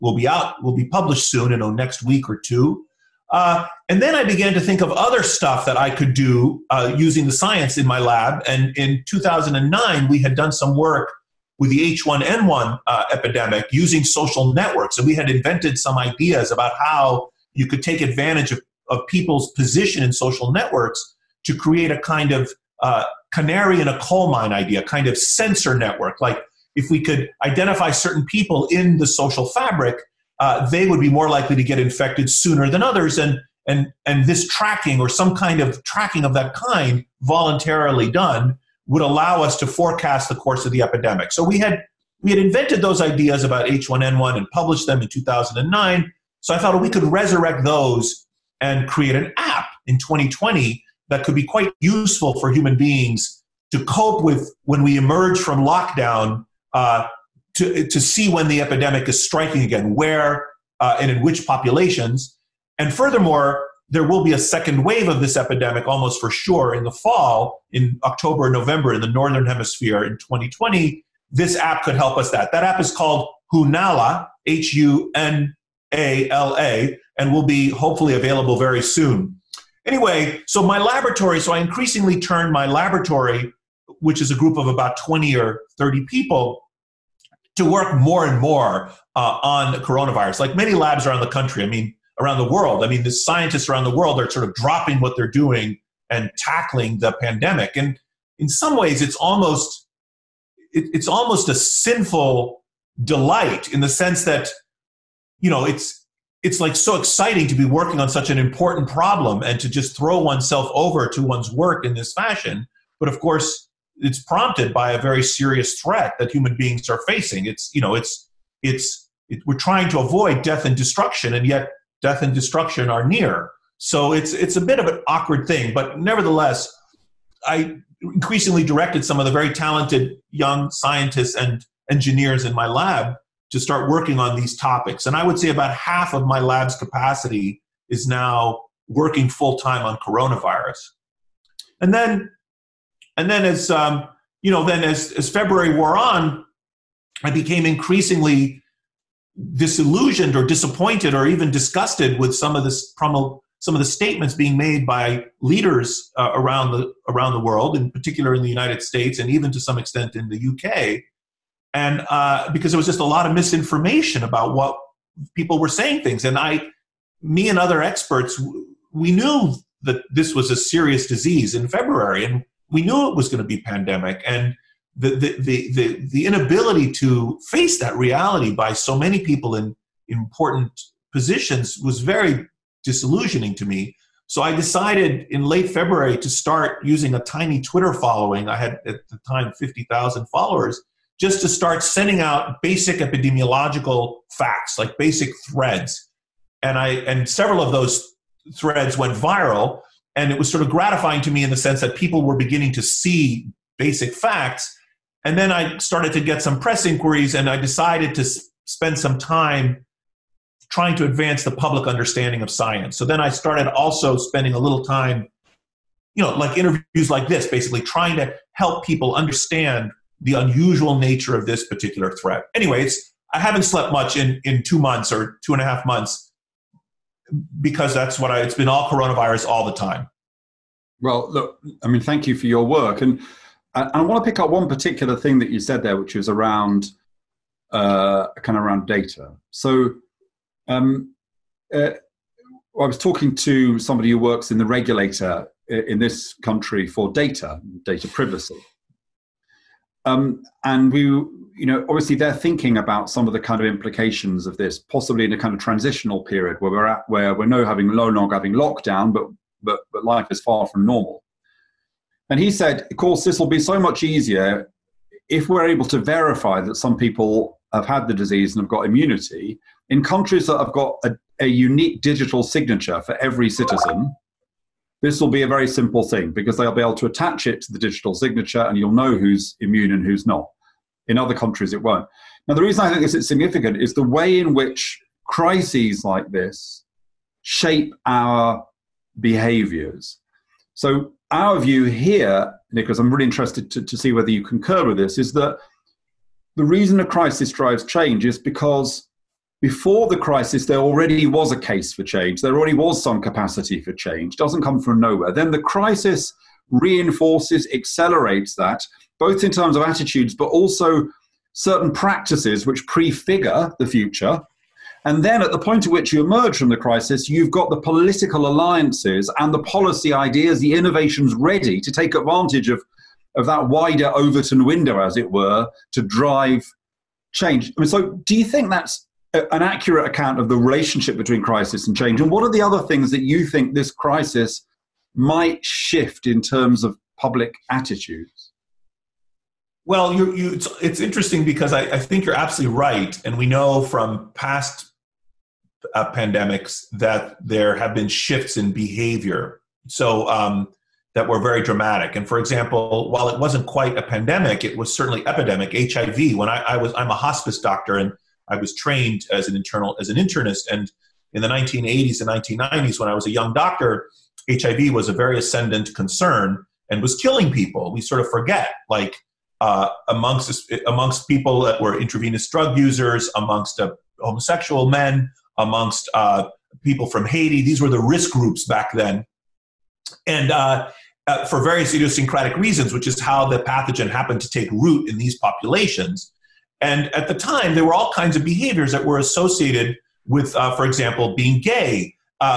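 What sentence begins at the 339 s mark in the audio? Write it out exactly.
Well, you, you, it's, it's, interesting because I, I, think you're absolutely right.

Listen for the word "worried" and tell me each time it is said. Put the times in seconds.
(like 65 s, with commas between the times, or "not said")
not said.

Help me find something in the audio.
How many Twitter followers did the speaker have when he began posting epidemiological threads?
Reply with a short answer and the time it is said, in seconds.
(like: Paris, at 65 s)
50,000, at 189 s.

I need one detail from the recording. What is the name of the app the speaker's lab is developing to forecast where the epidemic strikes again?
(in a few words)
Hunala.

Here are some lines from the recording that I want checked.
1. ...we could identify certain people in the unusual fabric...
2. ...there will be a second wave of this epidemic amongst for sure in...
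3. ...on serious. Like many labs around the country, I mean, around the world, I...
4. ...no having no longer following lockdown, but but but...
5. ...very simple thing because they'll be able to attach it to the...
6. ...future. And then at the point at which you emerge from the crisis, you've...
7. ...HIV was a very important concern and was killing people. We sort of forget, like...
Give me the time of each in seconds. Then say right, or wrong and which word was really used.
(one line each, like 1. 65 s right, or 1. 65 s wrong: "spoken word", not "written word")
1. 26 s wrong: "social", not "unusual"
2. 63 s wrong: "almost", not "amongst"
3. 89 s wrong: "coronavirus", not "serious"
4. 257 s wrong: "having", not "following"
5. 275 s right
6. 313 s right
7. 364 s wrong: "ascendant", not "important".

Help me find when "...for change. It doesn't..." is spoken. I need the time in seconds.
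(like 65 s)
303 s.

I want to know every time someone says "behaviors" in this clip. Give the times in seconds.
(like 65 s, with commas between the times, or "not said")
289 s, 348 s, 388 s.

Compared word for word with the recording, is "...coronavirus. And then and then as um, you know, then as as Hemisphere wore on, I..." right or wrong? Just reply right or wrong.
wrong.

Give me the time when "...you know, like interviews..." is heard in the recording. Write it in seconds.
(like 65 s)
216 s.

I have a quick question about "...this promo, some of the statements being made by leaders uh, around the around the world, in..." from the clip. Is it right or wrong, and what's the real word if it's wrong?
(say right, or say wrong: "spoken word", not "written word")
right.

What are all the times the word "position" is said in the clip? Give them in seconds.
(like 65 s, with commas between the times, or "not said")
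19 s, 181 s.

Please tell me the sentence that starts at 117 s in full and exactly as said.
It's you know it's it's it, we're trying to avoid death and destruction, and yet death and destruction are near.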